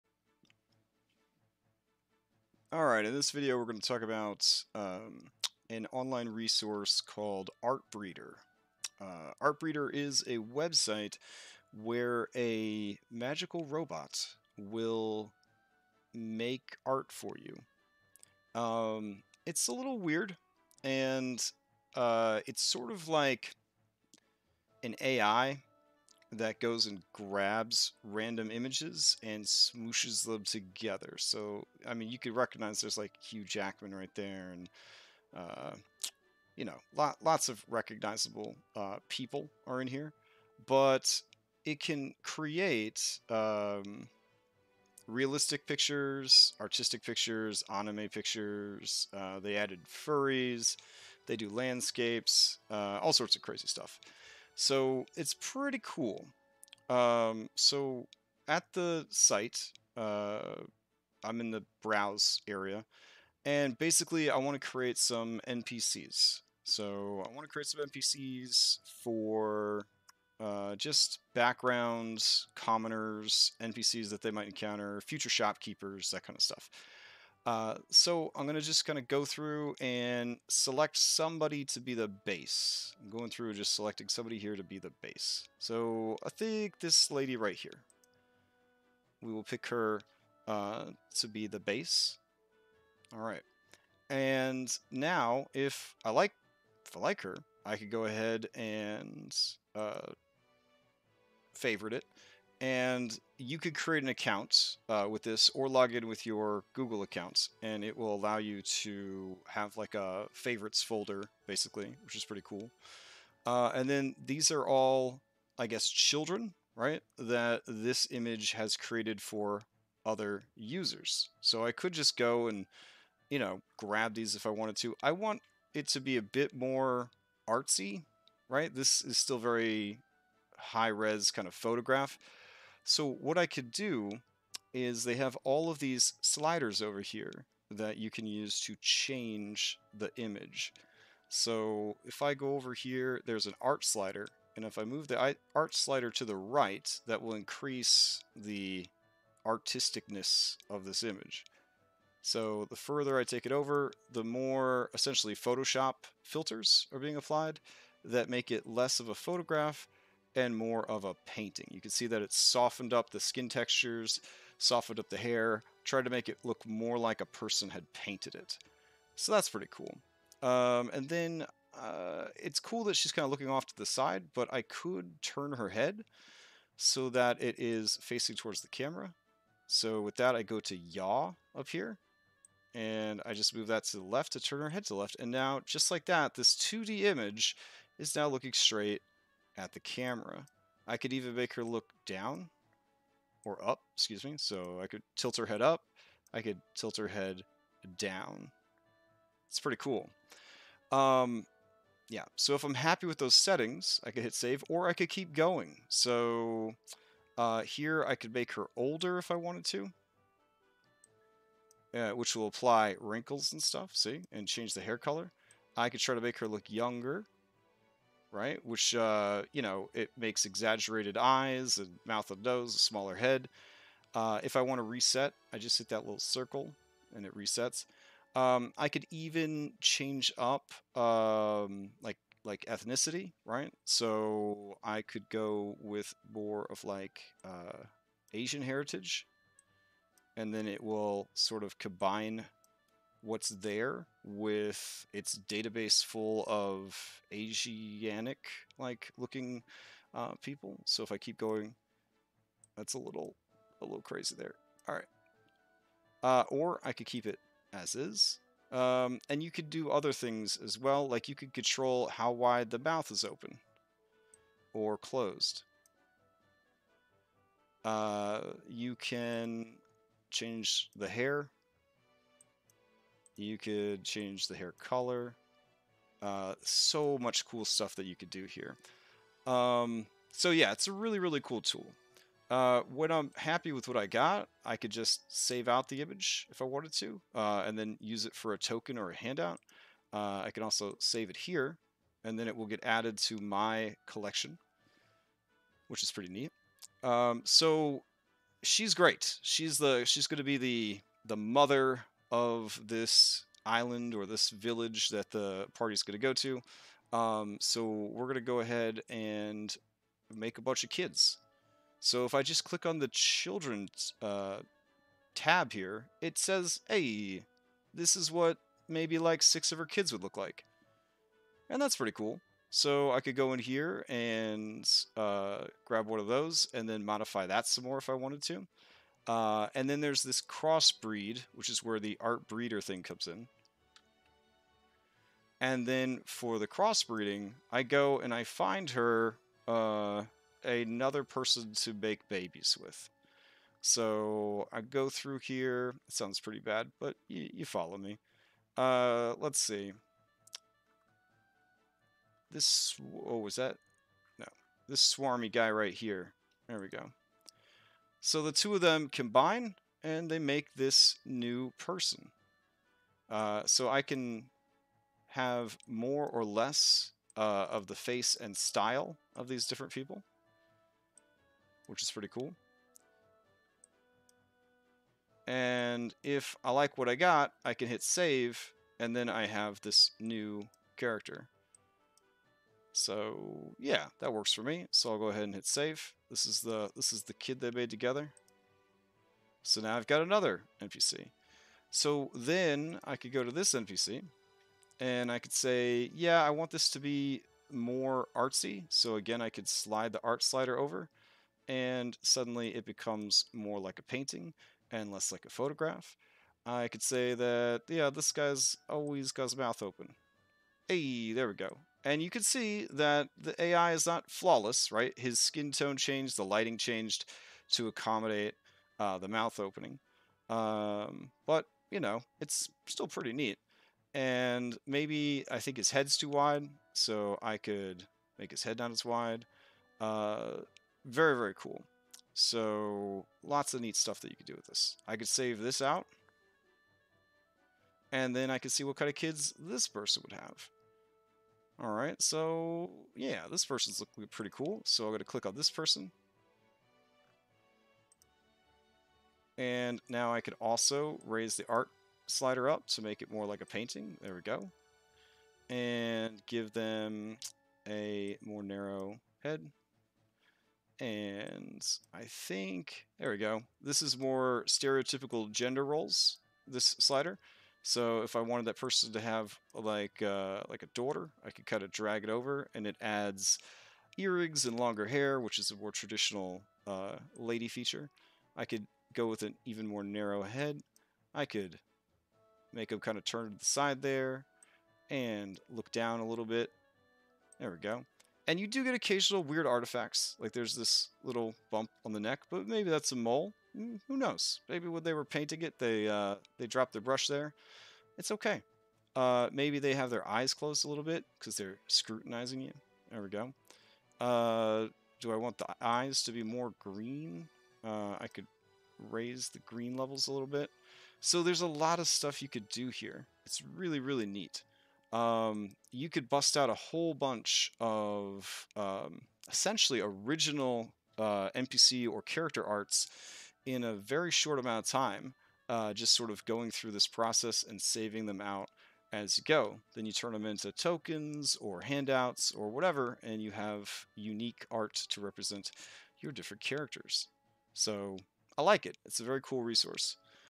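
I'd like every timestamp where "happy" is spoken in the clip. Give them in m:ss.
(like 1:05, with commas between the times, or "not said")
3:22, 4:43.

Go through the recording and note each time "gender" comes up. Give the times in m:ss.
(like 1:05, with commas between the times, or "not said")
7:45.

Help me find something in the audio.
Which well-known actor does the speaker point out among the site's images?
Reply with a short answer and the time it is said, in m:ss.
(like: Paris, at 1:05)
Hugh Jackman, at 0:33.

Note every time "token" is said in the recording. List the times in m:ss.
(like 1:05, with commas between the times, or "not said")
4:48, 8:50.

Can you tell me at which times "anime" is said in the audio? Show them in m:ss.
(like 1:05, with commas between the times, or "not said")
0:47.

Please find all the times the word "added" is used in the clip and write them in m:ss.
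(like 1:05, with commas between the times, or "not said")
0:49, 4:52.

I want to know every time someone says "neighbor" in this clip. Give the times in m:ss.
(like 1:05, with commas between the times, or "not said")
not said.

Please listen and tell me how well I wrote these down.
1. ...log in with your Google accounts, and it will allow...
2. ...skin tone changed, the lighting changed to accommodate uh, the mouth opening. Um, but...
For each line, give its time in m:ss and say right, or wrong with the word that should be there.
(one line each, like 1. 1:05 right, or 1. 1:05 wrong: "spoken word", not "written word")
1. 1:45 right
2. 6:55 right.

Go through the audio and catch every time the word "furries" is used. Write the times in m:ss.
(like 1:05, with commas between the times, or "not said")
0:49.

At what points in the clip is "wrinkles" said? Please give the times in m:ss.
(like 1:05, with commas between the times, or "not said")
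3:33.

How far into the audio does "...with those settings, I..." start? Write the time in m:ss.
3:23.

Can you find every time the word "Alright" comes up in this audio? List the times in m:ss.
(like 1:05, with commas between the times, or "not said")
0:02, 7:21.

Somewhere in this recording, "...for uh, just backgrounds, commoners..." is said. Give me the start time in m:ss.
1:09.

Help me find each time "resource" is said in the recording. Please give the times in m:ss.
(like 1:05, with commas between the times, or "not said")
0:06, 8:59.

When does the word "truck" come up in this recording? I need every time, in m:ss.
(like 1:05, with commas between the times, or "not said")
not said.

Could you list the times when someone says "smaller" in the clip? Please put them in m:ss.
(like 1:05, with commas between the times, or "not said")
3:42.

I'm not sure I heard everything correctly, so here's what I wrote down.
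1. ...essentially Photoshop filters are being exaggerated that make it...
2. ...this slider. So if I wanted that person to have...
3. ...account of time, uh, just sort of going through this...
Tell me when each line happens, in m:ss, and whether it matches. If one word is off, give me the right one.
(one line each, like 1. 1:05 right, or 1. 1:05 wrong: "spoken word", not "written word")
1. 2:34 wrong: "applied", not "exaggerated"
2. 7:46 right
3. 8:44 wrong: "amount", not "account".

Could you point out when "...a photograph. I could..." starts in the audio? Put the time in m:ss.
6:45.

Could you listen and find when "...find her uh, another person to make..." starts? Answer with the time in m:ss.
5:38.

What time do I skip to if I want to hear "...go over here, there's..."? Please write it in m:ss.
2:22.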